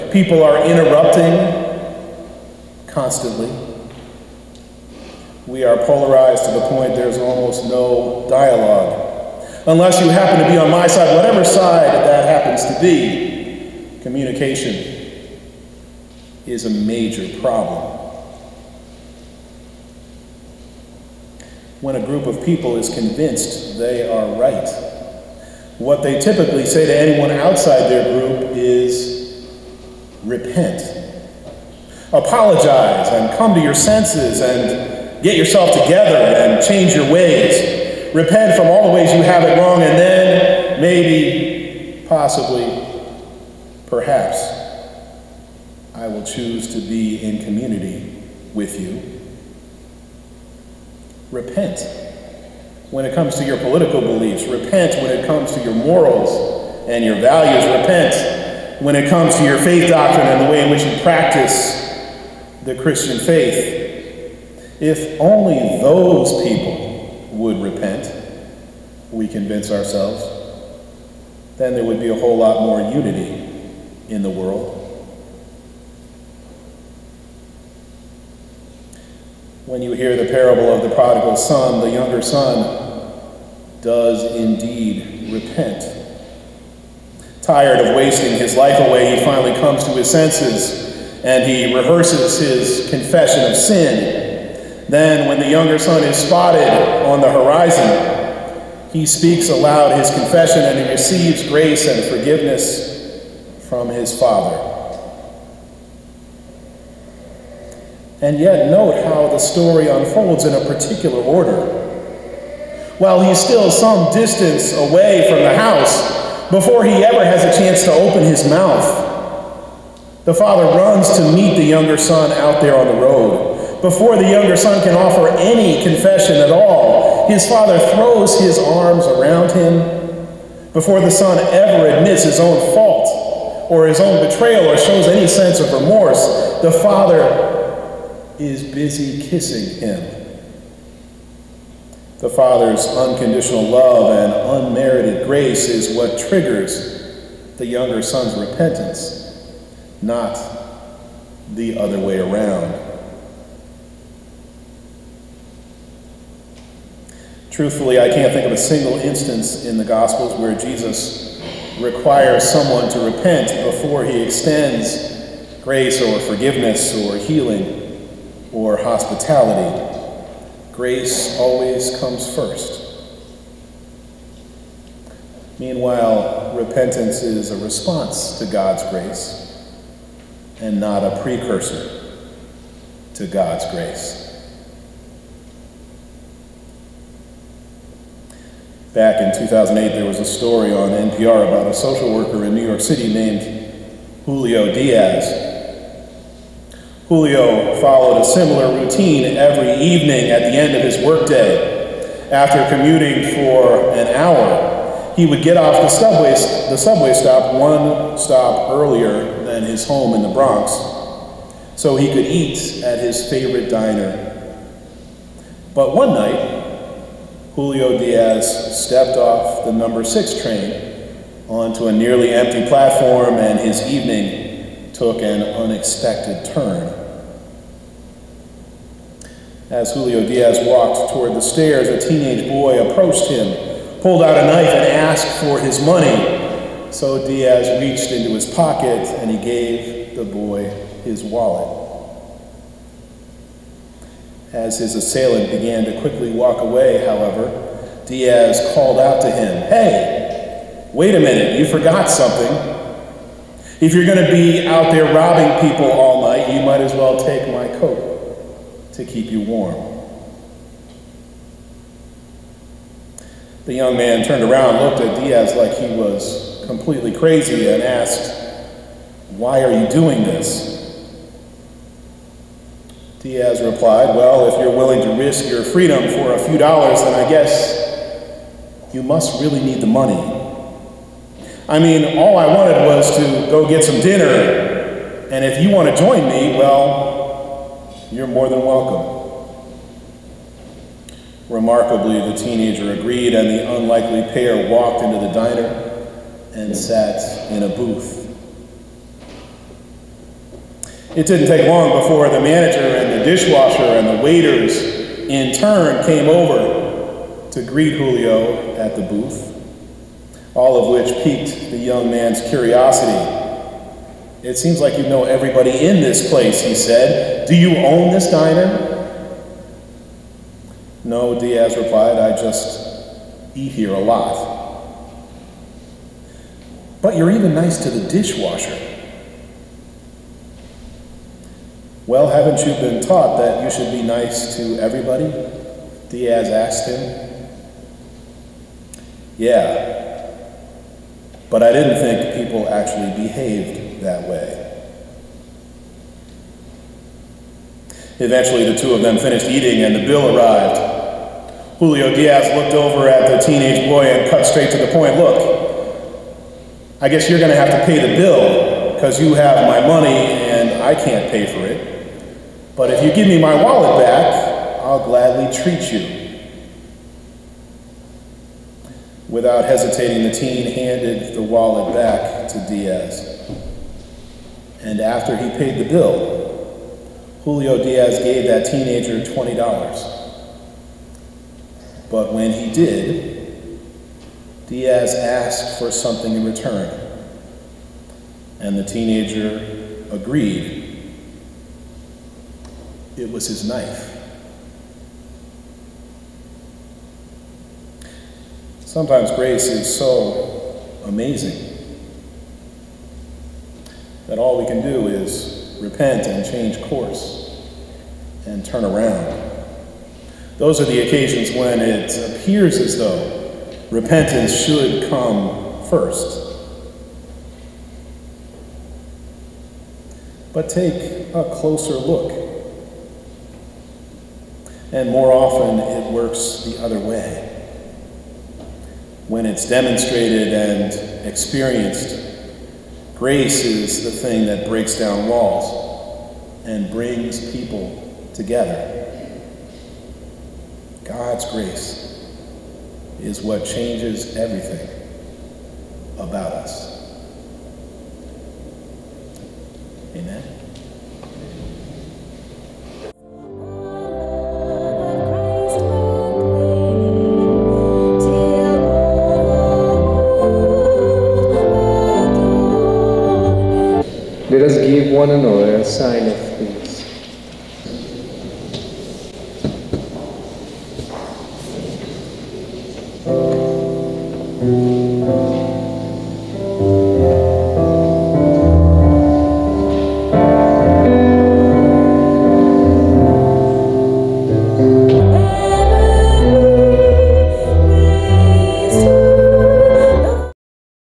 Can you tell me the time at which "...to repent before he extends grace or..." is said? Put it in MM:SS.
02:42.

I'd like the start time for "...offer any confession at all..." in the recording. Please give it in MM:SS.
02:04.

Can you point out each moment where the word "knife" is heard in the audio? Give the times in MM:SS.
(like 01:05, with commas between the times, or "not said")
03:54, 06:33.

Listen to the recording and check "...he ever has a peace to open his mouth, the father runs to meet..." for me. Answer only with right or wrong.
wrong.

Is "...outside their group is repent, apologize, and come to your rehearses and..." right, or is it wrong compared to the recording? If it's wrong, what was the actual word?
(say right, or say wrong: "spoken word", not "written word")
wrong: "senses", not "rehearses".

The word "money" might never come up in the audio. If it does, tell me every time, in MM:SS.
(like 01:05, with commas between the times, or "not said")
03:55, 04:39, 05:59.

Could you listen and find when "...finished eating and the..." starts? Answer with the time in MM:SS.
05:49.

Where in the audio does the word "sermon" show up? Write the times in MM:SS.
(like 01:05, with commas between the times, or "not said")
not said.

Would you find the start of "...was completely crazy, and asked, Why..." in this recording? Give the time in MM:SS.
04:25.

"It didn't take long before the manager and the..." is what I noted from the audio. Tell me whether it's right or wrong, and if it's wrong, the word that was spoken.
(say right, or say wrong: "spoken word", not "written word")
right.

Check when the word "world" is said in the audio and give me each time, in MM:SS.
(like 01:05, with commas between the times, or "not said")
01:14.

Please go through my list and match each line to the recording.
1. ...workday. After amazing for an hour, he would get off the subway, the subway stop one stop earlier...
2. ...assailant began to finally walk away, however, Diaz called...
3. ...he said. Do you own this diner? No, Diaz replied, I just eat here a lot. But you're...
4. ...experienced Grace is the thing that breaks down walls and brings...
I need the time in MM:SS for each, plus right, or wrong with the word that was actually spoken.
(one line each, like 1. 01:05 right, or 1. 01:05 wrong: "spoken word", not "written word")
1. 03:21 wrong: "commuting", not "amazing"
2. 04:04 wrong: "quickly", not "finally"
3. 05:16 right
4. 07:11 right.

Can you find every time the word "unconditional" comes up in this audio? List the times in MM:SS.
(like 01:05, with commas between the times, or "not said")
02:22.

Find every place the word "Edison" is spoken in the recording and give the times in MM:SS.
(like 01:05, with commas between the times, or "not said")
not said.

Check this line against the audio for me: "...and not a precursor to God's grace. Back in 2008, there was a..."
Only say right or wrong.
right.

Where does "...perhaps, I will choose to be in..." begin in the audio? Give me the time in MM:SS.
00:43.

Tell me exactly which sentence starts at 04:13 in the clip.
If you're going to be out there robbing people all night, you might as well take my coat to keep you warm.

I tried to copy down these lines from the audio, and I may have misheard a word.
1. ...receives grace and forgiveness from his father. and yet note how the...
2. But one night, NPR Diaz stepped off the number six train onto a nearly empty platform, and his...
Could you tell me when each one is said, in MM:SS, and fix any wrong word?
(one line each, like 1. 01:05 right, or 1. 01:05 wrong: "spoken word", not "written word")
1. 01:40 right
2. 03:35 wrong: "Julio", not "NPR".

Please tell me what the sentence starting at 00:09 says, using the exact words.
Unless you happen to be on my side, whatever side that happens to be, communication is a major problem.